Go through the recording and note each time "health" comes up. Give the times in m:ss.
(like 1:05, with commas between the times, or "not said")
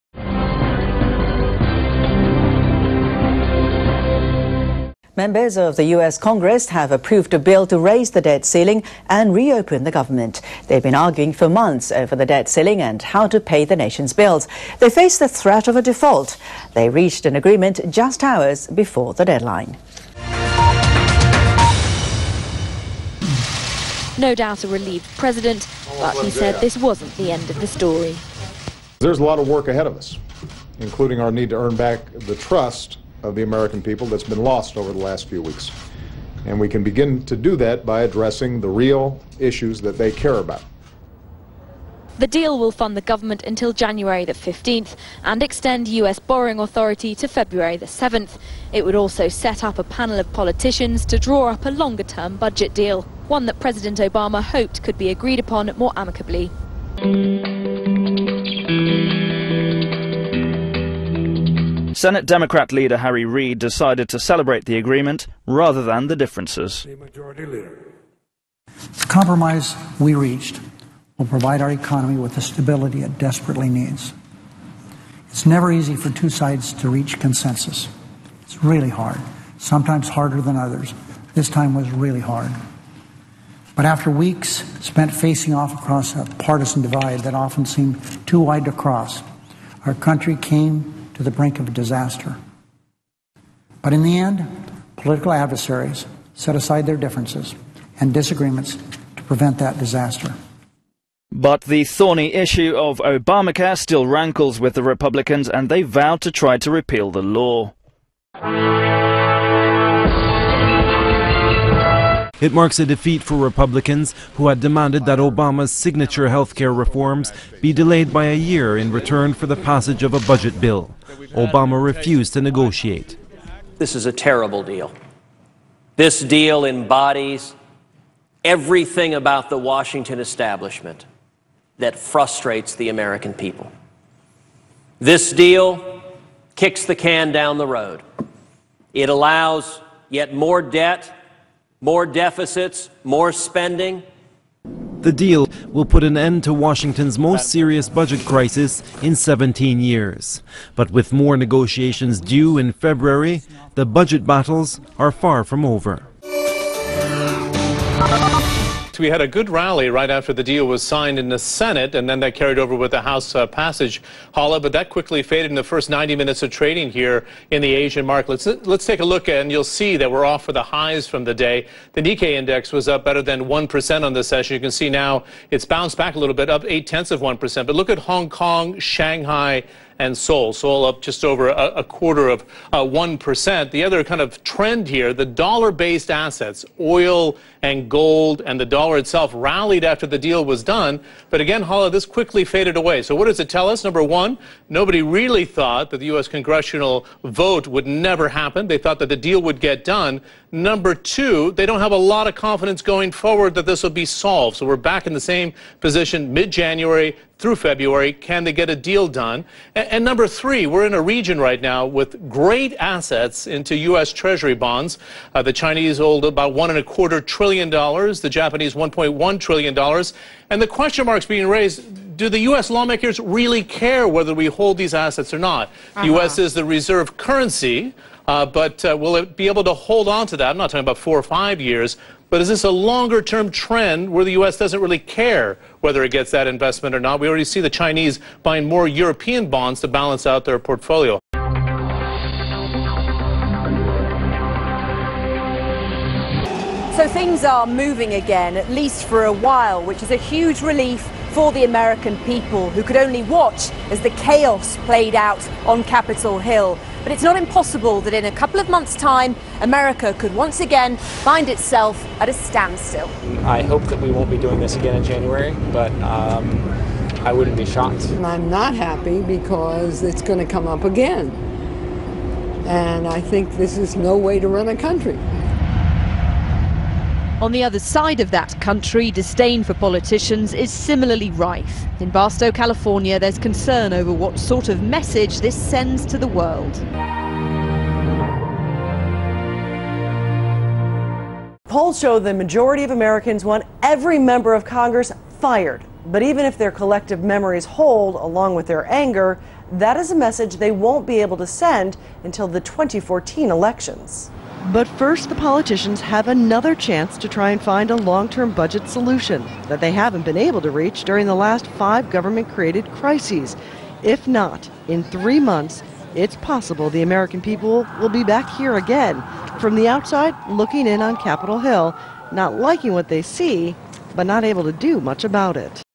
1:56.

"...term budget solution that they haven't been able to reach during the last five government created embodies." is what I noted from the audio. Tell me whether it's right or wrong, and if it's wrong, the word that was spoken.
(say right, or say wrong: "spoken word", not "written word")
wrong: "crises", not "embodies".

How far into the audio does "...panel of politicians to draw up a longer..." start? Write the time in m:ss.
0:49.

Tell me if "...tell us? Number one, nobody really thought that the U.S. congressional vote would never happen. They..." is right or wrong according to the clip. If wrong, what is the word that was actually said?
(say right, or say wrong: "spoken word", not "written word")
right.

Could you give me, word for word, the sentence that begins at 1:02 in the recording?
Senate Democrat leader Harry Reid decided to celebrate the agreement rather than the differences.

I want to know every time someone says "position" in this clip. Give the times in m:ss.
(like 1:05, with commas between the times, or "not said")
3:25.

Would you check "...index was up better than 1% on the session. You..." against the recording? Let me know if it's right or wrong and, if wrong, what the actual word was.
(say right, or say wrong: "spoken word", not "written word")
right.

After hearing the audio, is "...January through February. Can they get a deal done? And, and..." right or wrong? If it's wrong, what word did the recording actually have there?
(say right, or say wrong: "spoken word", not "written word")
right.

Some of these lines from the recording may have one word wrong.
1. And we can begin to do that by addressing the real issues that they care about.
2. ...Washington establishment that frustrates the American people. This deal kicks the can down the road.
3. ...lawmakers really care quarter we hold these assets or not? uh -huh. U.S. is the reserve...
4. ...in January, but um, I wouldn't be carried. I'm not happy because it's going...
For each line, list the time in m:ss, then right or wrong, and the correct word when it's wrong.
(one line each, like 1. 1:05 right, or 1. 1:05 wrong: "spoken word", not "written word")
1. 0:36 right
2. 2:09 right
3. 3:42 wrong: "whether", not "quarter"
4. 4:24 wrong: "shocked", not "carried".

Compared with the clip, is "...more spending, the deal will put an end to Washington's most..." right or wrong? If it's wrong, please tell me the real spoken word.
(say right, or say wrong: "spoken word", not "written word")
right.